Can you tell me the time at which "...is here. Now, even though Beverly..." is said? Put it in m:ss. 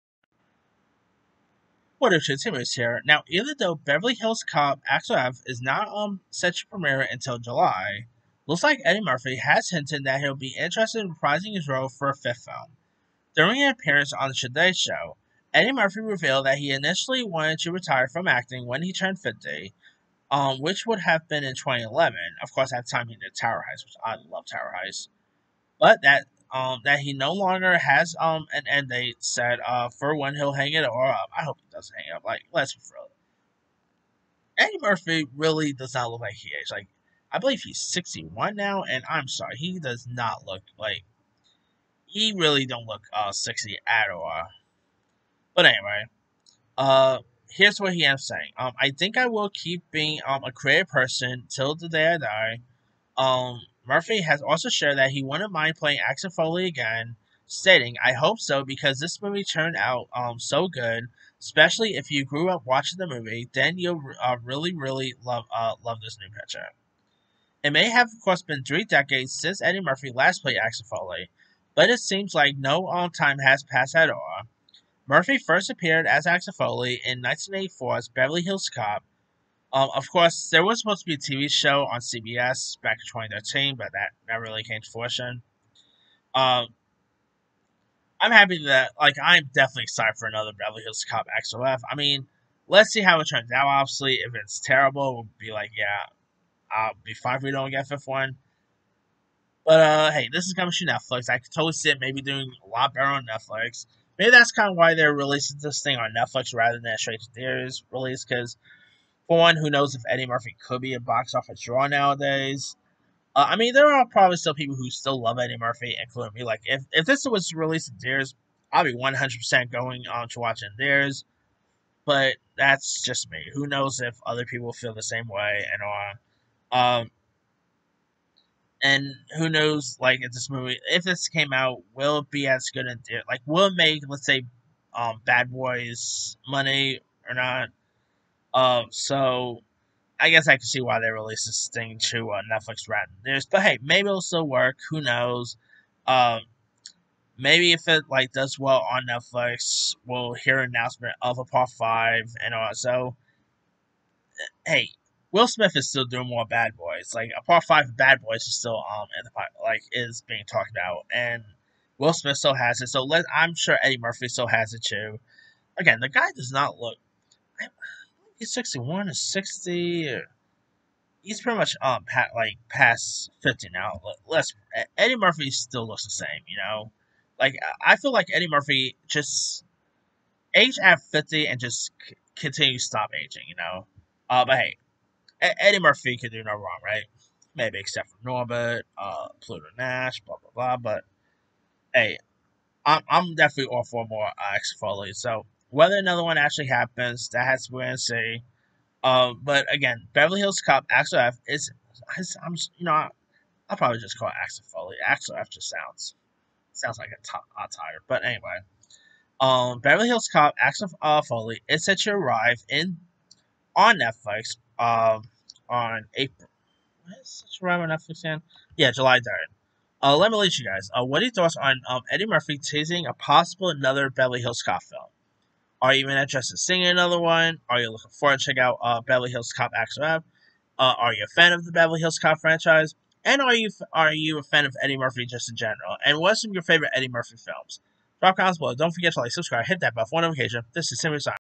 0:02.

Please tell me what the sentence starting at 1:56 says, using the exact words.
Like, if, if this was released in theaters, I'd be 100% going on to watching theirs.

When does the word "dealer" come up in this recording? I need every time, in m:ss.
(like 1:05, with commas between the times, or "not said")
not said.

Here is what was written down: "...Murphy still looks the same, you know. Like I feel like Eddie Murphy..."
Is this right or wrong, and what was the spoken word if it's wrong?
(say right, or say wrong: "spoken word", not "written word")
right.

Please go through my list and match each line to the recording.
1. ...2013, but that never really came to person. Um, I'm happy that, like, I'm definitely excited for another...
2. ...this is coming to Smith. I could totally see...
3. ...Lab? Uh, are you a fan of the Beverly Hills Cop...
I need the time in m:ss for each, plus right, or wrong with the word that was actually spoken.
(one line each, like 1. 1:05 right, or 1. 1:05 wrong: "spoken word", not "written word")
1. 1:23 wrong: "fruition", not "person"
2. 1:40 wrong: "Netflix", not "Smith"
3. 3:50 right.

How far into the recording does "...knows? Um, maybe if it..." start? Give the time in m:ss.
2:25.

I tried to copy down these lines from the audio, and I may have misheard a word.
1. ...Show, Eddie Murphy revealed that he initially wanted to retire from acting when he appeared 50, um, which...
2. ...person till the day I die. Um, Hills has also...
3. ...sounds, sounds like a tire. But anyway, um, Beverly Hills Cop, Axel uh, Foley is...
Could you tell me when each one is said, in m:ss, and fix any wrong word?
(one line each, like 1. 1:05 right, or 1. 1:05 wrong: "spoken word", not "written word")
1. 0:14 wrong: "turned", not "appeared"
2. 0:50 wrong: "Murphy", not "Hills"
3. 3:25 right.